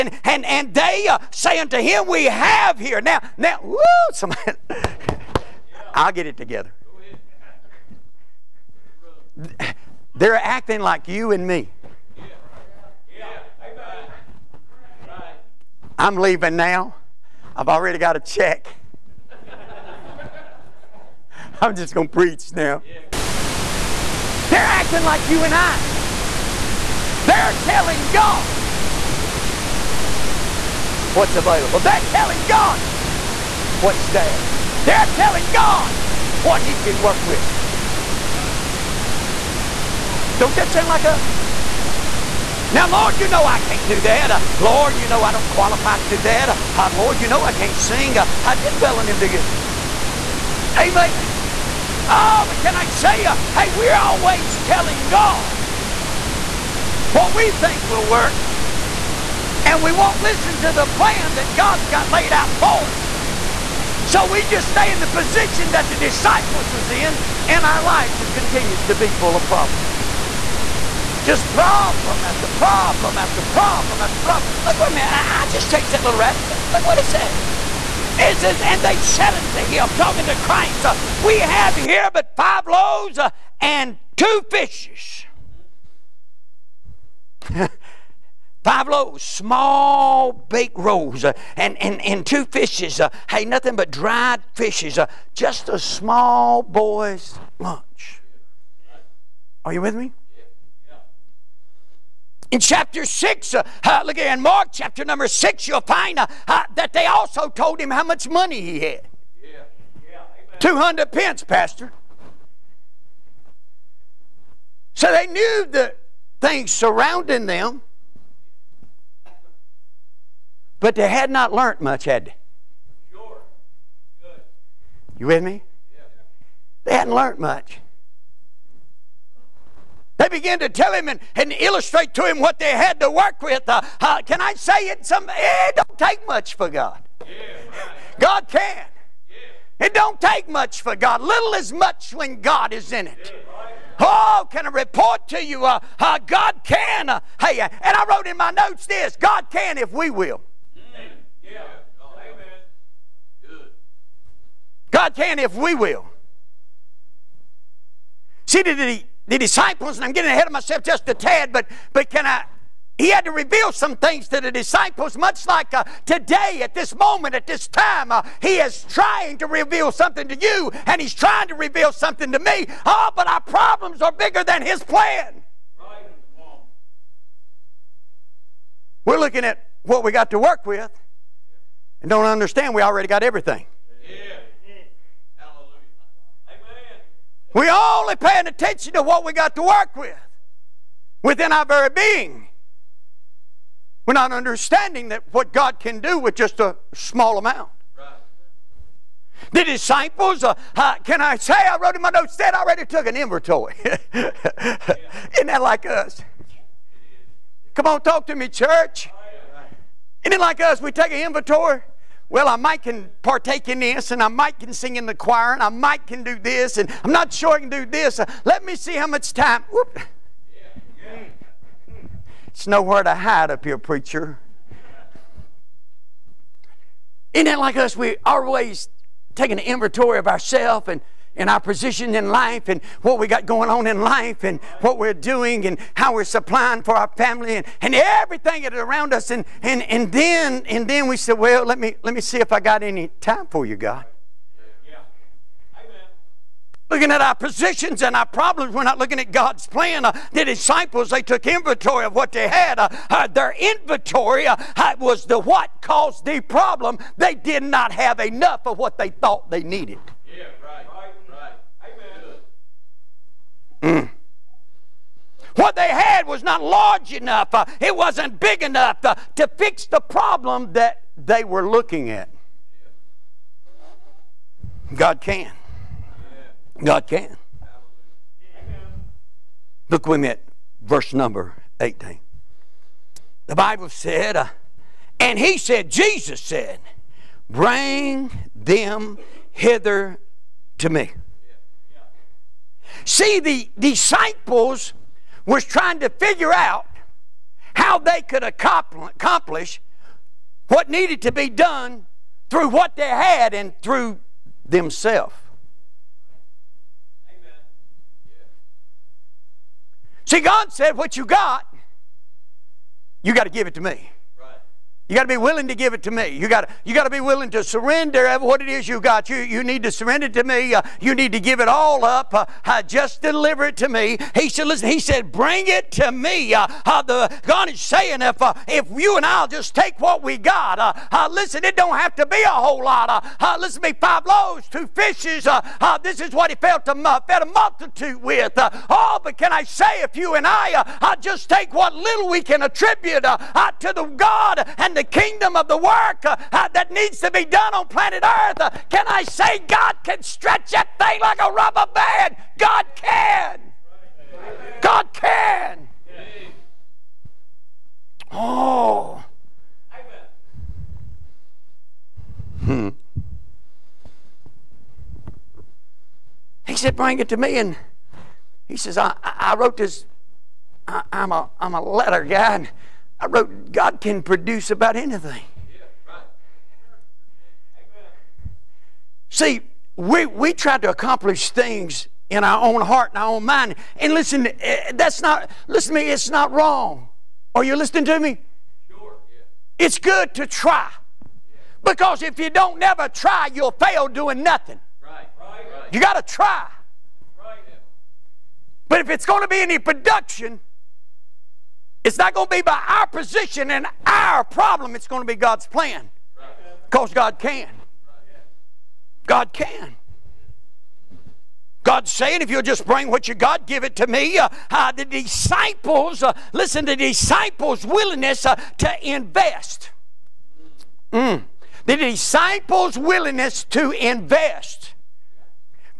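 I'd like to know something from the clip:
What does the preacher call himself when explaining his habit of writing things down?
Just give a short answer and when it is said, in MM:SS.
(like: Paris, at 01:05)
A letter guy, at 06:11.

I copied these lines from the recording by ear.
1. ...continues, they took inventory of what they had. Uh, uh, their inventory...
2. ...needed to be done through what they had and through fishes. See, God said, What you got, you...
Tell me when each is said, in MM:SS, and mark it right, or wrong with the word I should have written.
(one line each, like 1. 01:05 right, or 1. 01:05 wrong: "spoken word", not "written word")
1. 04:10 wrong: "disciples", not "continues"
2. 05:00 wrong: "themselves", not "fishes".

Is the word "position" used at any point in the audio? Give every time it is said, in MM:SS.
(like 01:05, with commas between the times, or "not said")
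01:05, 03:51, 04:07, 06:43.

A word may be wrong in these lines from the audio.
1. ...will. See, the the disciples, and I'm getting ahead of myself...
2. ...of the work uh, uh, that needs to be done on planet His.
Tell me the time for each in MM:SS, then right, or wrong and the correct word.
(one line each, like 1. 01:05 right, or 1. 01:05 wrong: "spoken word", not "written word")
1. 02:35 right
2. 05:45 wrong: "Earth", not "His".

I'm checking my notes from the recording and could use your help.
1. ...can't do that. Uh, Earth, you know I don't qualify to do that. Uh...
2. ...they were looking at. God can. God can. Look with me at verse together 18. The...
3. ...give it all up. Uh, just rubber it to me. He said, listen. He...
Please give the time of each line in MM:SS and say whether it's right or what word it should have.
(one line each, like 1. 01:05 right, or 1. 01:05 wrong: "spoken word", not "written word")
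1. 00:43 wrong: "Lord", not "Earth"
2. 04:31 wrong: "number", not "together"
3. 05:21 wrong: "deliver", not "rubber".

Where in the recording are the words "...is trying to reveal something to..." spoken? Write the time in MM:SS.
02:48.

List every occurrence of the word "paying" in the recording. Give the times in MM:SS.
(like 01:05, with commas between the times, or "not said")
03:08.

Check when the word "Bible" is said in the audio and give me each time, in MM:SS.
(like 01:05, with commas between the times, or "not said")
04:43.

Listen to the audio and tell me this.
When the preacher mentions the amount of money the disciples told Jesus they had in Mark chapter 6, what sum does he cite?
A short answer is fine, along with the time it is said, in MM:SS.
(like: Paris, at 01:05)
200 pence, at 01:50.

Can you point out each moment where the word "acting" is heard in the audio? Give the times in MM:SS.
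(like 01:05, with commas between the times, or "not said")
00:10, 00:24.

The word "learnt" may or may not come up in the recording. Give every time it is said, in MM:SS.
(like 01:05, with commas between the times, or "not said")
02:01, 02:07.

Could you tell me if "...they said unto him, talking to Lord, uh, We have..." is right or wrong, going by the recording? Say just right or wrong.
wrong.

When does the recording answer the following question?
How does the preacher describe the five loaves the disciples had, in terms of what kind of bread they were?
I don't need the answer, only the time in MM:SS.
01:29.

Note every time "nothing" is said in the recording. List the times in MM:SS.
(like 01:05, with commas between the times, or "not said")
01:33, 06:34.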